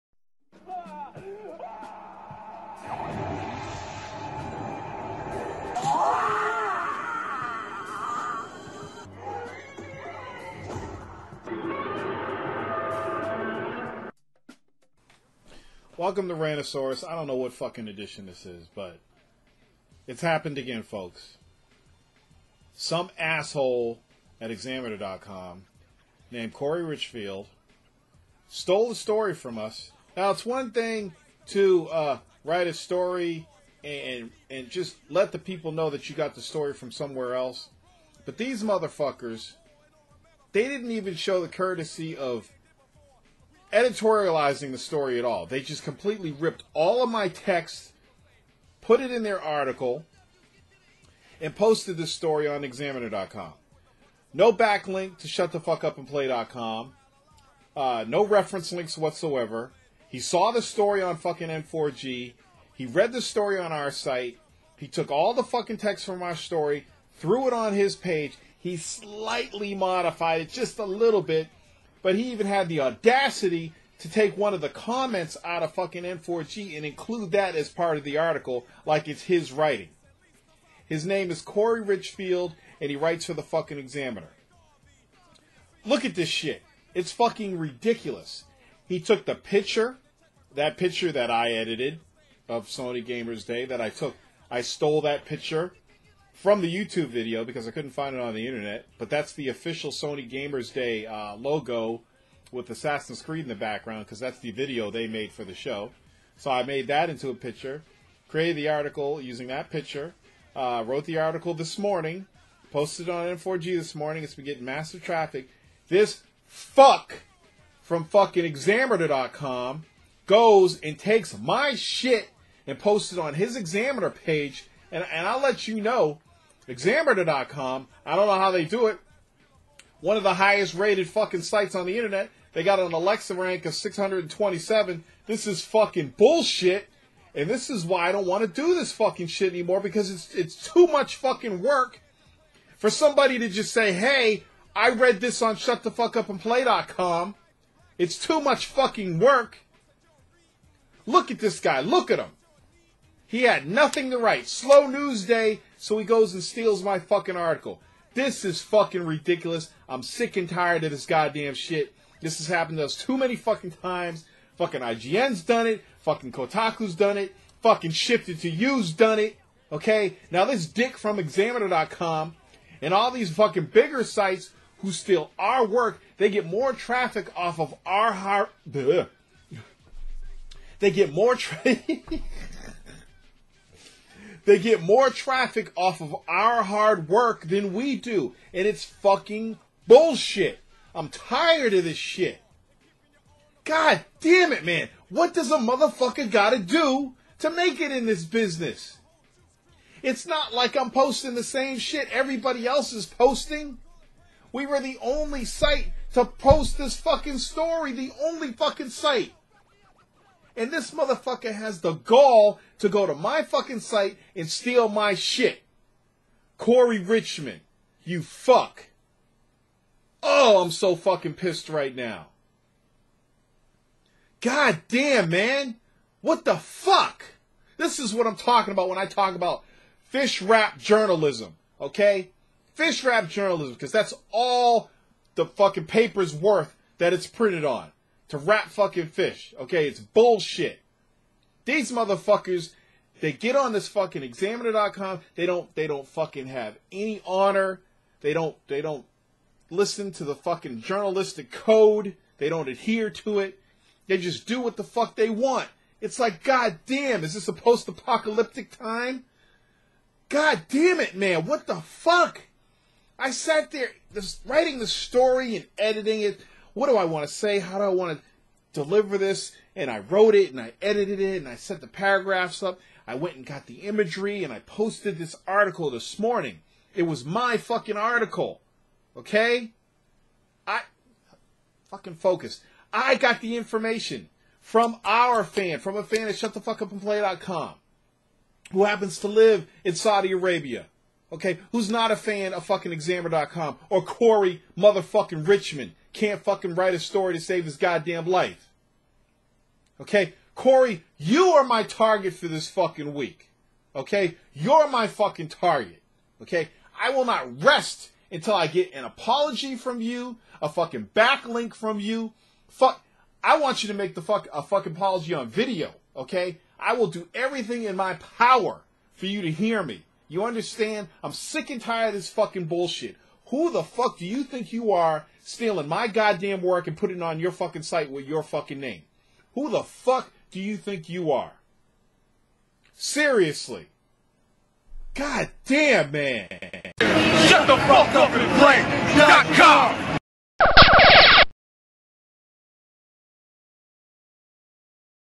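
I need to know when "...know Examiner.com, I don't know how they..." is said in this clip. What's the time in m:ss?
2:05.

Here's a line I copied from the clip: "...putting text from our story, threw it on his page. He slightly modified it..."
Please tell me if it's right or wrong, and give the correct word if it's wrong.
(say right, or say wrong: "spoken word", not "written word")
wrong: "fucking", not "putting".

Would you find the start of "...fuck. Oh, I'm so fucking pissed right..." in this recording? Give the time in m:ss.
3:38.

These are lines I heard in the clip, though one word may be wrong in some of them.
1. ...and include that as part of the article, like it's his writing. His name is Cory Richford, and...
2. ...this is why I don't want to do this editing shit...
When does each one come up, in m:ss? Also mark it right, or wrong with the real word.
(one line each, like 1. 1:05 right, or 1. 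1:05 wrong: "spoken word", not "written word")
1. 1:16 right
2. 2:17 wrong: "fucking", not "editing".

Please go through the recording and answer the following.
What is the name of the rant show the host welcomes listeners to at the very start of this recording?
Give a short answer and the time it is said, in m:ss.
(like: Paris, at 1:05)
Rantasaurus, at 0:16.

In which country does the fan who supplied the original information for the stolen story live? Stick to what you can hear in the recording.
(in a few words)
Saudi Arabia.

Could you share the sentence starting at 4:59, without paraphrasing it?
Okay, Cory, you are my target for this fucking week.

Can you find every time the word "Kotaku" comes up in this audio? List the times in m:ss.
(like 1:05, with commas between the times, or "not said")
2:46.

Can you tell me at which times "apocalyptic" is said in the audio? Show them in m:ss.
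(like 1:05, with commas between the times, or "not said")
4:17.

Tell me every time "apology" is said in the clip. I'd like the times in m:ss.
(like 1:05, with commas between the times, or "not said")
5:09, 5:14.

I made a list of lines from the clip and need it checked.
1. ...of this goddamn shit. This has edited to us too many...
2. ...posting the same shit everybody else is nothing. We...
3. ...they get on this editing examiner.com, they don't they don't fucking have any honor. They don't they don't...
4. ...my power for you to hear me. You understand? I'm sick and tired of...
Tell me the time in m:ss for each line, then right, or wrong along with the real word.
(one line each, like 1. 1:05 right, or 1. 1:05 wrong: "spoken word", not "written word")
1. 2:40 wrong: "happened", not "edited"
2. 3:20 wrong: "posting", not "nothing"
3. 4:03 wrong: "fucking", not "editing"
4. 5:17 right.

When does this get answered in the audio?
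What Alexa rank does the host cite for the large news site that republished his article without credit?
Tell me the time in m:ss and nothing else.
2:13.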